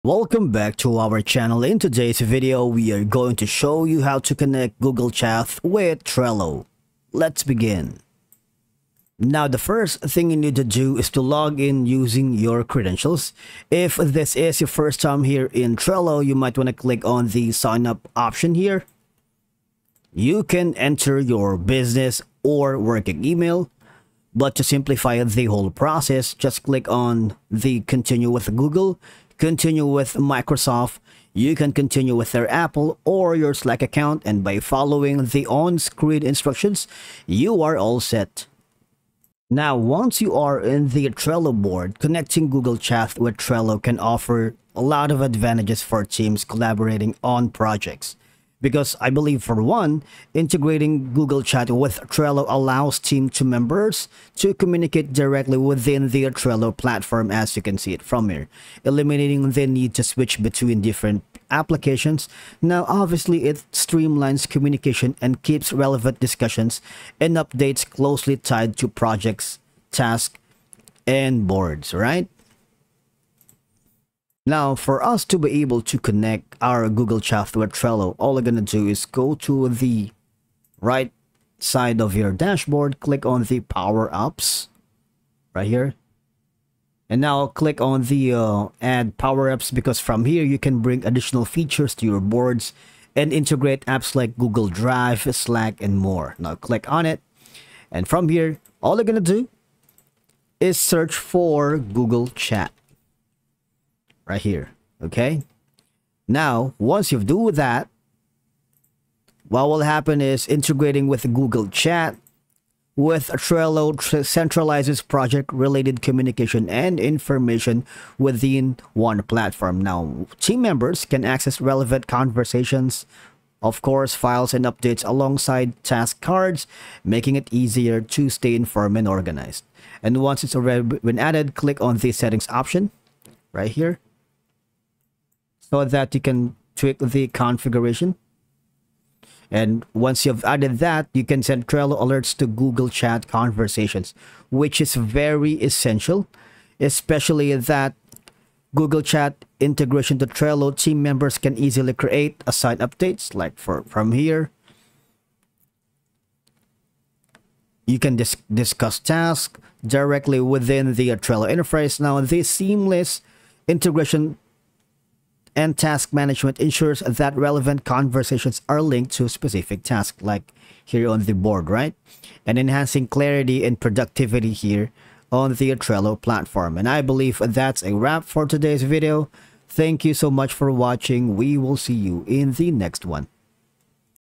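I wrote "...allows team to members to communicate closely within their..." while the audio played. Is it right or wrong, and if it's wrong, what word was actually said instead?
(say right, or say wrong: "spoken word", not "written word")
wrong: "directly", not "closely".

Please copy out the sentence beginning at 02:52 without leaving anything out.
And enhancing clarity and productivity here on the Trello platform.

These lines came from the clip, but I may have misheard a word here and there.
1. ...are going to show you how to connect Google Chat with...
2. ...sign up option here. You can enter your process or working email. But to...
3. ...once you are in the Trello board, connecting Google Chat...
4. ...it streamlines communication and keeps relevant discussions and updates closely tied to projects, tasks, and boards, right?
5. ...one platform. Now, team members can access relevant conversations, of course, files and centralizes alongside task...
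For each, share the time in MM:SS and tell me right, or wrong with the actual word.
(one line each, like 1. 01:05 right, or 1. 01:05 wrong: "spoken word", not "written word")
1. 00:02 right
2. 00:17 wrong: "business", not "process"
3. 00:39 right
4. 01:03 right
5. 01:58 wrong: "updates", not "centralizes".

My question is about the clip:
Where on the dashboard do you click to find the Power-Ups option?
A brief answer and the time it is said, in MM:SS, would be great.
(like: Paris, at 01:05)
Right side, at 01:20.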